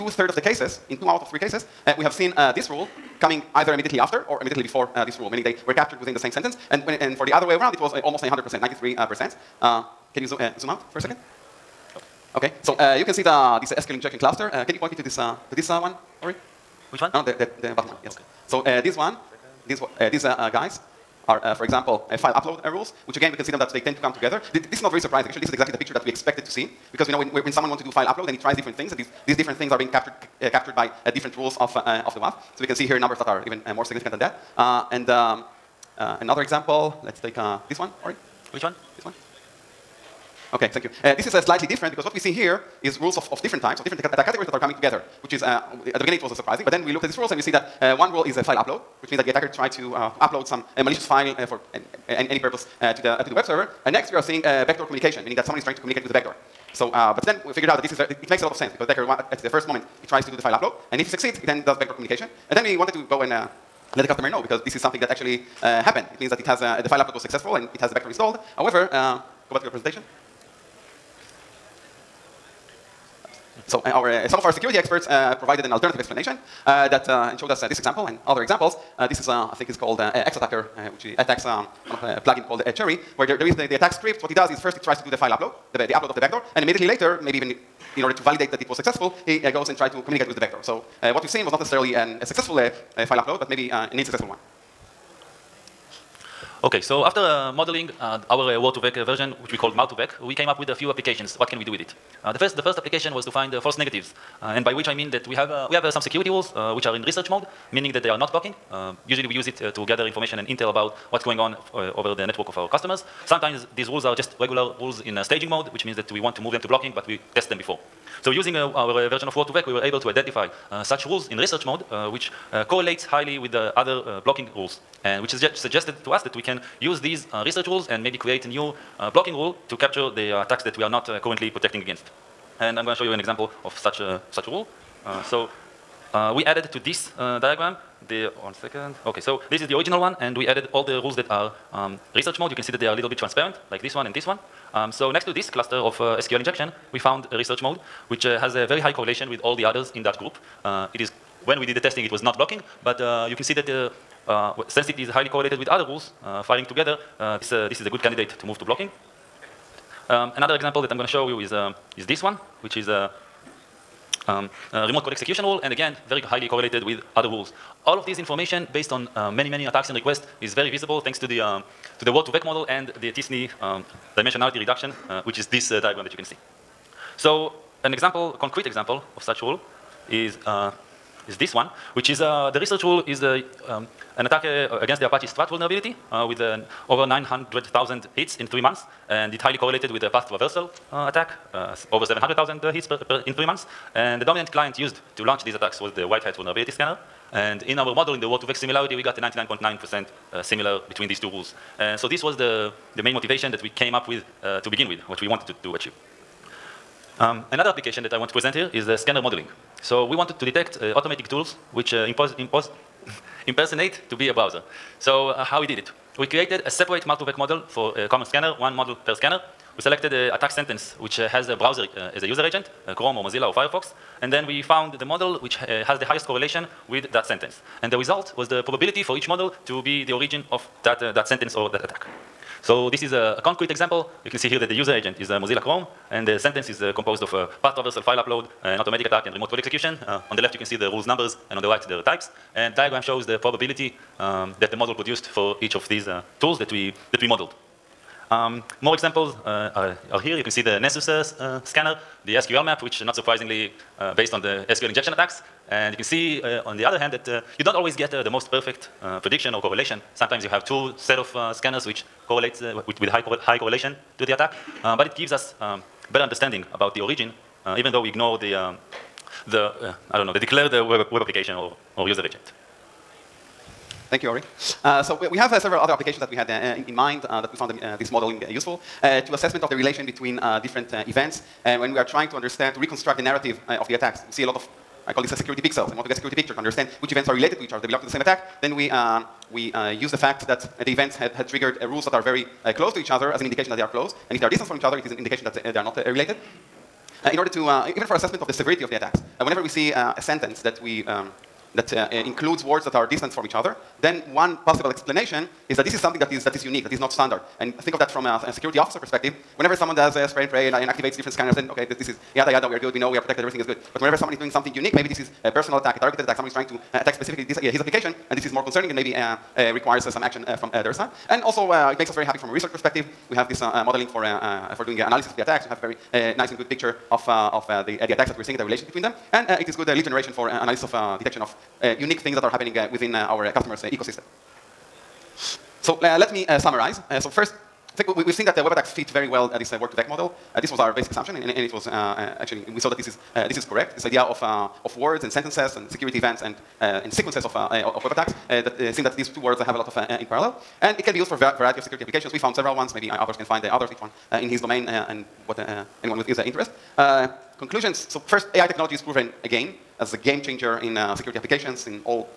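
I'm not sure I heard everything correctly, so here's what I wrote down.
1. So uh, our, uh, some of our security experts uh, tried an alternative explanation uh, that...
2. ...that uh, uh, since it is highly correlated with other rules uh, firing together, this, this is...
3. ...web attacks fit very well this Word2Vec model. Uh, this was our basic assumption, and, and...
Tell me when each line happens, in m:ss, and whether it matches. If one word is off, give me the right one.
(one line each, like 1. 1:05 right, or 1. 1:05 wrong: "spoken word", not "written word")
1. 1:13 wrong: "provided", not "tried"
2. 2:33 right
3. 5:38 right.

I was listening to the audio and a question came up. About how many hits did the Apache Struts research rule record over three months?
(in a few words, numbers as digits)
900,000.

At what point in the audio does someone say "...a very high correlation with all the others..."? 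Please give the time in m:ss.
2:28.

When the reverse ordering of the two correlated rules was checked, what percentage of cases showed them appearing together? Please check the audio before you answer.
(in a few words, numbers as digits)
93%.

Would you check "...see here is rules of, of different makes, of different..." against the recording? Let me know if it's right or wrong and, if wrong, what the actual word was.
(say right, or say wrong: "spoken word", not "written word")
wrong: "types", not "makes".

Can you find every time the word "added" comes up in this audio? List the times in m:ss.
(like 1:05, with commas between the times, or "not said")
2:16, 2:20.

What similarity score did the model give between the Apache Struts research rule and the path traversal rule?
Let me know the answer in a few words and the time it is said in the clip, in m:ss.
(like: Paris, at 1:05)
99.9%, at 3:19.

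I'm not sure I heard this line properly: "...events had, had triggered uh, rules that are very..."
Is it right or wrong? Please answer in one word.
right.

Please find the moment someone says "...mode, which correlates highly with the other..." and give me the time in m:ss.
2:01.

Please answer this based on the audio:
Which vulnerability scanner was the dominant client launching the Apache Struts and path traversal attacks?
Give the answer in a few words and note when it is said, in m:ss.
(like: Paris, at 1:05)
White Hat, at 3:16.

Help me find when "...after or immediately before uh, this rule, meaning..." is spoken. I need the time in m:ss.
0:03.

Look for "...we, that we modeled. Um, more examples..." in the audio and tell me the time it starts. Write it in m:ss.
4:06.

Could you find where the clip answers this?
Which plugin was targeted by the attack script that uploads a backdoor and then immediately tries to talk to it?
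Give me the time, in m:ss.
1:22.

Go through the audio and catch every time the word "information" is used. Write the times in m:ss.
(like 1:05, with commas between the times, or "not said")
1:50, 2:48.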